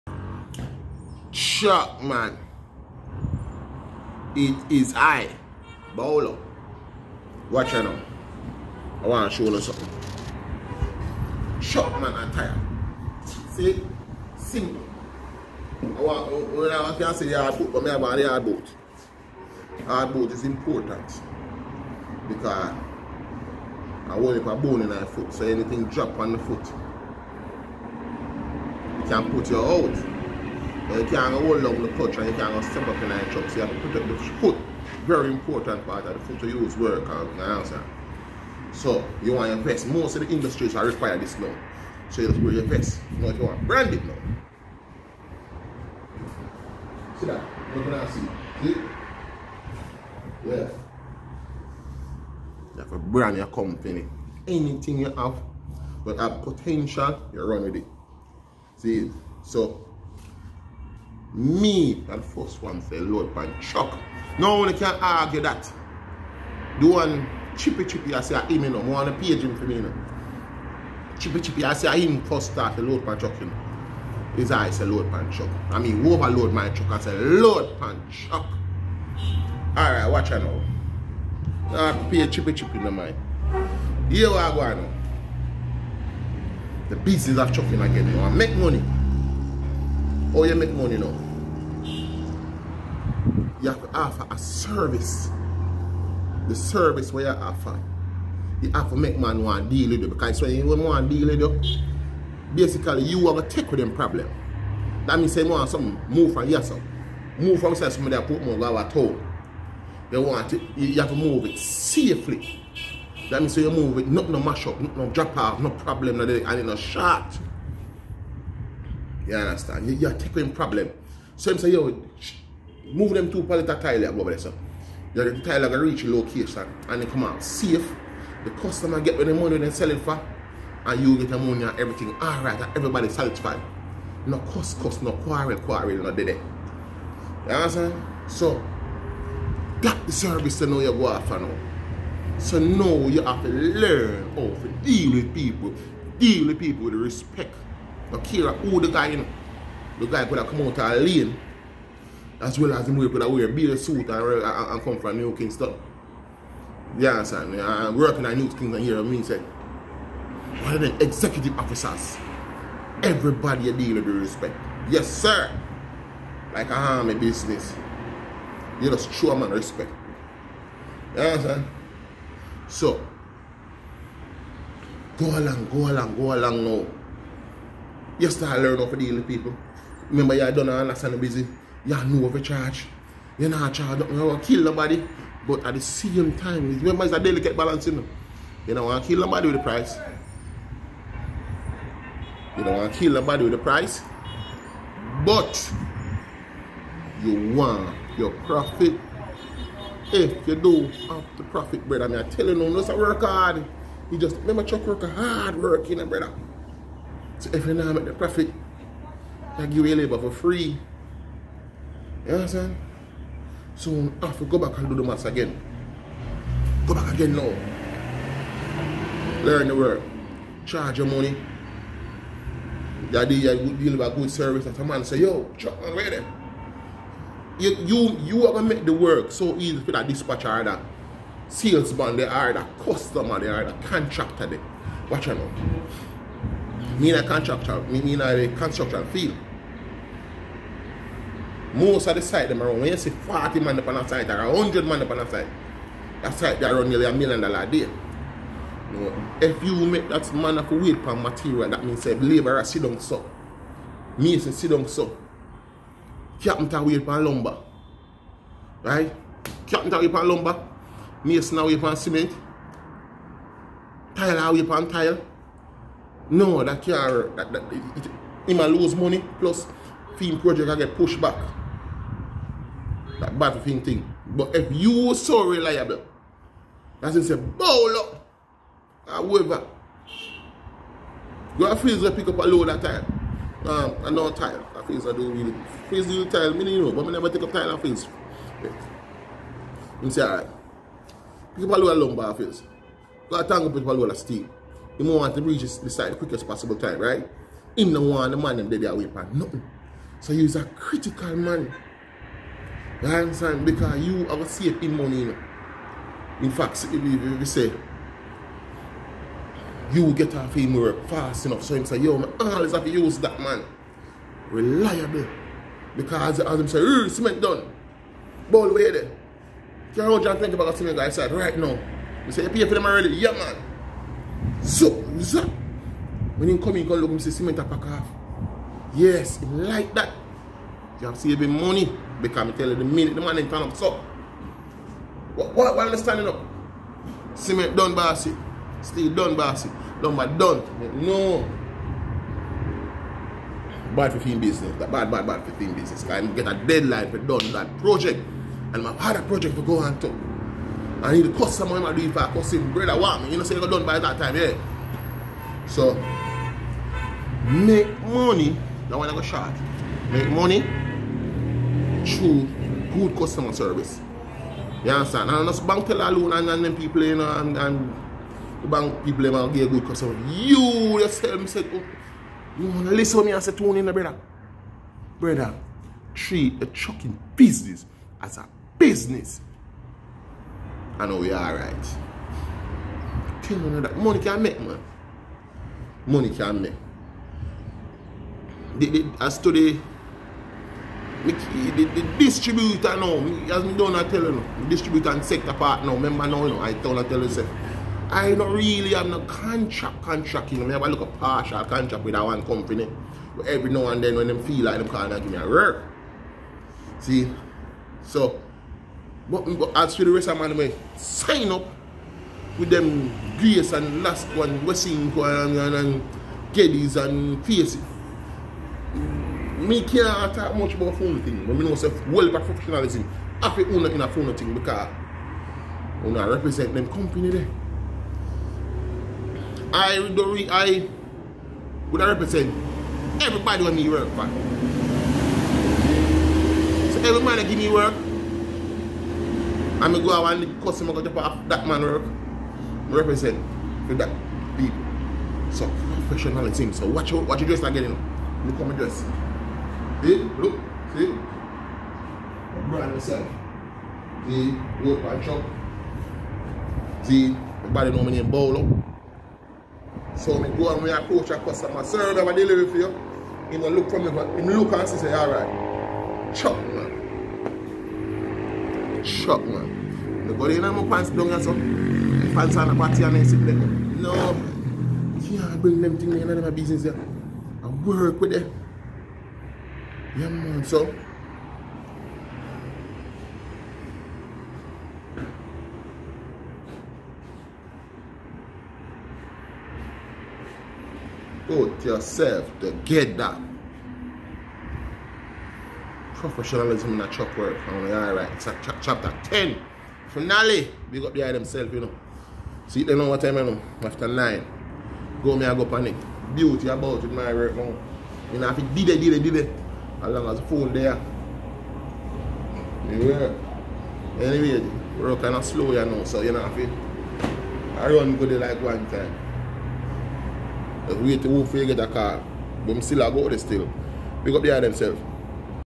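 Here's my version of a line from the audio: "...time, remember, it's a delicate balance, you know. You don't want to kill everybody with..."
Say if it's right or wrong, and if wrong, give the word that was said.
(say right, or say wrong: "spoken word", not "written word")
wrong: "nobody", not "everybody".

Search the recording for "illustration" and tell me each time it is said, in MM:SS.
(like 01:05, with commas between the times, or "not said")
not said.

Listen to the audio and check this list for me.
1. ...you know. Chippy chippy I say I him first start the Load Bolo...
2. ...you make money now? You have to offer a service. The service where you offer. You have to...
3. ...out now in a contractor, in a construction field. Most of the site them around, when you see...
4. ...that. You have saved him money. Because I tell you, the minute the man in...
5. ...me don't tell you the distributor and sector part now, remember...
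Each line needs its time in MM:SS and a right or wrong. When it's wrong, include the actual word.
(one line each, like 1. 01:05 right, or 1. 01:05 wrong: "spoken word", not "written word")
1. 01:09 wrong: "Pan", not "Bolo"
2. 01:30 right
3. 03:55 right
4. 05:29 right
5. 06:33 right.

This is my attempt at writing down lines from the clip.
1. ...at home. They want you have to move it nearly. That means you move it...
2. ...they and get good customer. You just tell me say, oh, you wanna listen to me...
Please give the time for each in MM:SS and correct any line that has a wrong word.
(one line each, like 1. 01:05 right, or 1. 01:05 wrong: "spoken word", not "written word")
1. 01:48 wrong: "safely", not "nearly"
2. 06:09 right.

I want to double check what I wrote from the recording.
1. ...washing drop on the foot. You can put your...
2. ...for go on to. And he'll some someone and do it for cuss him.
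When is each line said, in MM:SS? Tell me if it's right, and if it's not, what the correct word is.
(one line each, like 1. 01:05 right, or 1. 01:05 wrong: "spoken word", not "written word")
1. 00:25 wrong: "anything", not "washing"
2. 05:49 right.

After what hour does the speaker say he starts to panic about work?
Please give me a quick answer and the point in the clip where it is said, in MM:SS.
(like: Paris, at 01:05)
9, at 08:23.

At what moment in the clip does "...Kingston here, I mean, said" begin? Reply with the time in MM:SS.
02:38.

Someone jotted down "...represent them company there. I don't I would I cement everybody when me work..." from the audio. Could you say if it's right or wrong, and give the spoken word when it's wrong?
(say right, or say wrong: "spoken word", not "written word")
wrong: "represent", not "cement".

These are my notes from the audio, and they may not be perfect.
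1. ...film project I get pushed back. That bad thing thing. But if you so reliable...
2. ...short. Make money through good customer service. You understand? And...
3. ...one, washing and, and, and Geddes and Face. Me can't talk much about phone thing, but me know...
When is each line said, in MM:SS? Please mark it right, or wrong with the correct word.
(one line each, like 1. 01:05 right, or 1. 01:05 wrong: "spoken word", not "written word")
1. 04:30 right
2. 05:59 right
3. 06:54 right.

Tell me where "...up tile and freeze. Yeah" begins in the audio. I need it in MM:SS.
04:47.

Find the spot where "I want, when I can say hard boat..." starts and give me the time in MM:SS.
00:15.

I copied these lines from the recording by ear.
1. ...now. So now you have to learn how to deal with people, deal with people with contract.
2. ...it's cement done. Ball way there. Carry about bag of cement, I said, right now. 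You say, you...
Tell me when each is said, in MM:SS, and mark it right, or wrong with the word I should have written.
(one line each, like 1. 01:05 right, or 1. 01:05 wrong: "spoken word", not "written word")
1. 02:21 wrong: "respect", not "contract"
2. 05:16 right.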